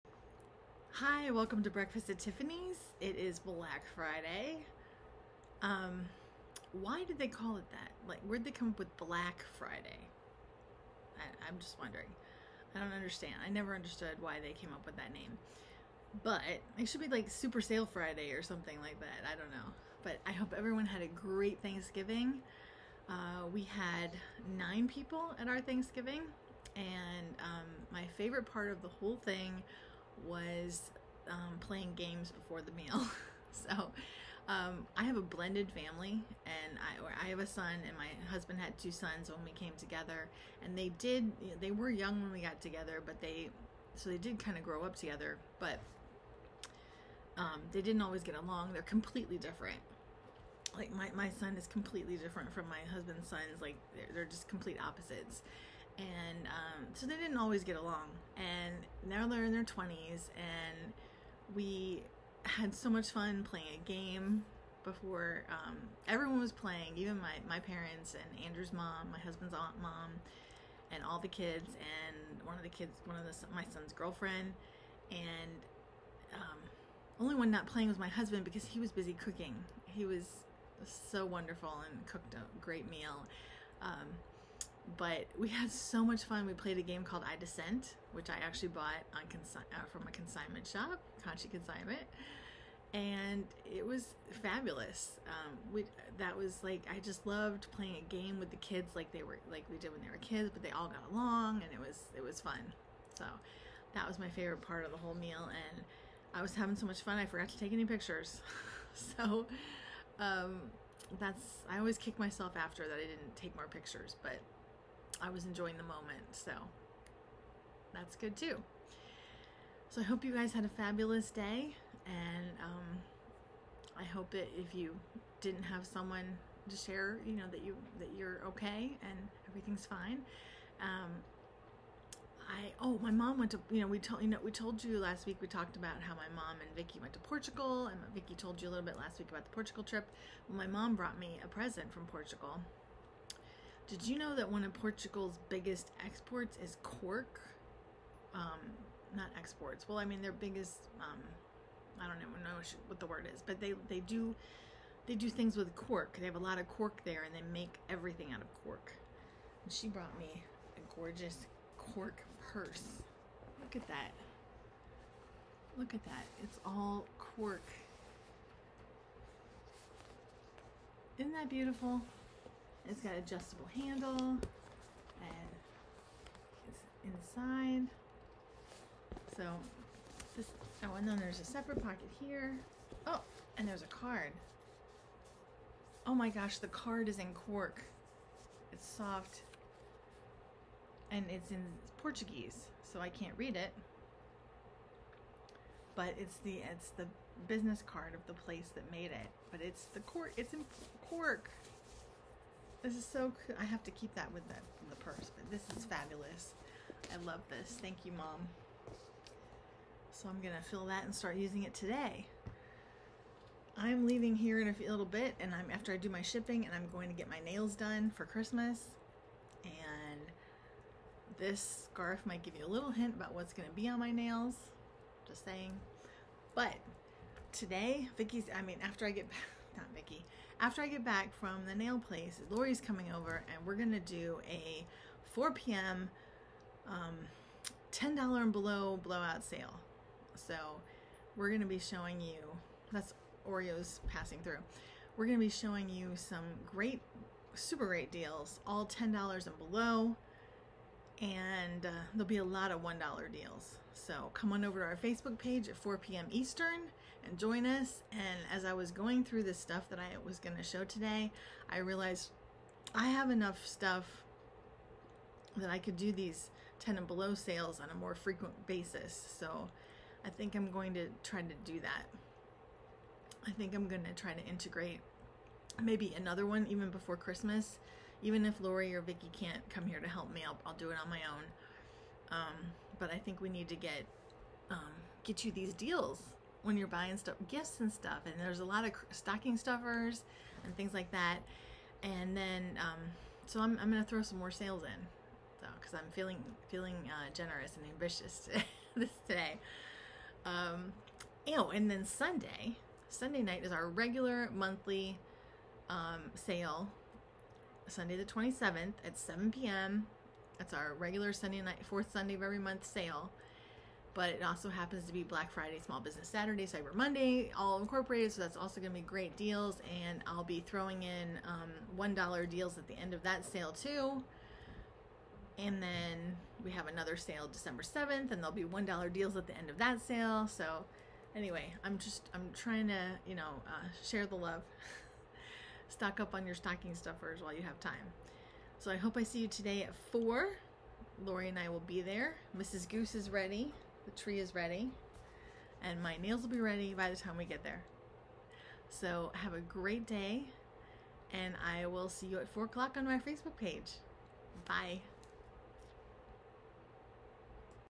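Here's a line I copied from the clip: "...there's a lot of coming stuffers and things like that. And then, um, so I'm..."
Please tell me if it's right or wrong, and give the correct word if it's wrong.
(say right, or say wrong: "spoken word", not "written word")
wrong: "stocking", not "coming".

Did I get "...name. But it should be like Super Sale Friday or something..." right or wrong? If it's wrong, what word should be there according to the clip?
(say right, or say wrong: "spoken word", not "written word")
right.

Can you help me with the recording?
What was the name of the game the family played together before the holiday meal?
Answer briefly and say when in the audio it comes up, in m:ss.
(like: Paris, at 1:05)
I Descent, at 1:27.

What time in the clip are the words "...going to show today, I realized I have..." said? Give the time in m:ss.
4:20.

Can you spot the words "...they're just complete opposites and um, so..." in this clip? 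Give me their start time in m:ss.
0:54.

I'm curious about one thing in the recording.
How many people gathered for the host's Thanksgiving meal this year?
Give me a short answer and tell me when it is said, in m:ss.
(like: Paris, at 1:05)
9, at 0:24.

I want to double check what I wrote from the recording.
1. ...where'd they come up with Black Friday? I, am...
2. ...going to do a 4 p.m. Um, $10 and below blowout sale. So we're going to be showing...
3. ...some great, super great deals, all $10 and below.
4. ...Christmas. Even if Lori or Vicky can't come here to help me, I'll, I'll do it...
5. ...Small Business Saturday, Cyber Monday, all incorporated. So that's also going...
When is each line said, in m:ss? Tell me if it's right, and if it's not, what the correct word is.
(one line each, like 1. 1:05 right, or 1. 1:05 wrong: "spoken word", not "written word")
1. 0:08 right
2. 3:53 right
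3. 4:06 right
4. 4:37 right
5. 5:15 right.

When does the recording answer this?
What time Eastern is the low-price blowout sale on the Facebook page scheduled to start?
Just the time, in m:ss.
4:15.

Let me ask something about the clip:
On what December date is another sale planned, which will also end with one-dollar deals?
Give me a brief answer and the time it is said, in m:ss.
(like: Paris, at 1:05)
December 7th, at 5:27.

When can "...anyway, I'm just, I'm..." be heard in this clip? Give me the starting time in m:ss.
5:31.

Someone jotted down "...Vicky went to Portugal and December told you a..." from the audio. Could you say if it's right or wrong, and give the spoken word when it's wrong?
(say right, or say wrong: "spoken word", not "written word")
wrong: "Vicky", not "December".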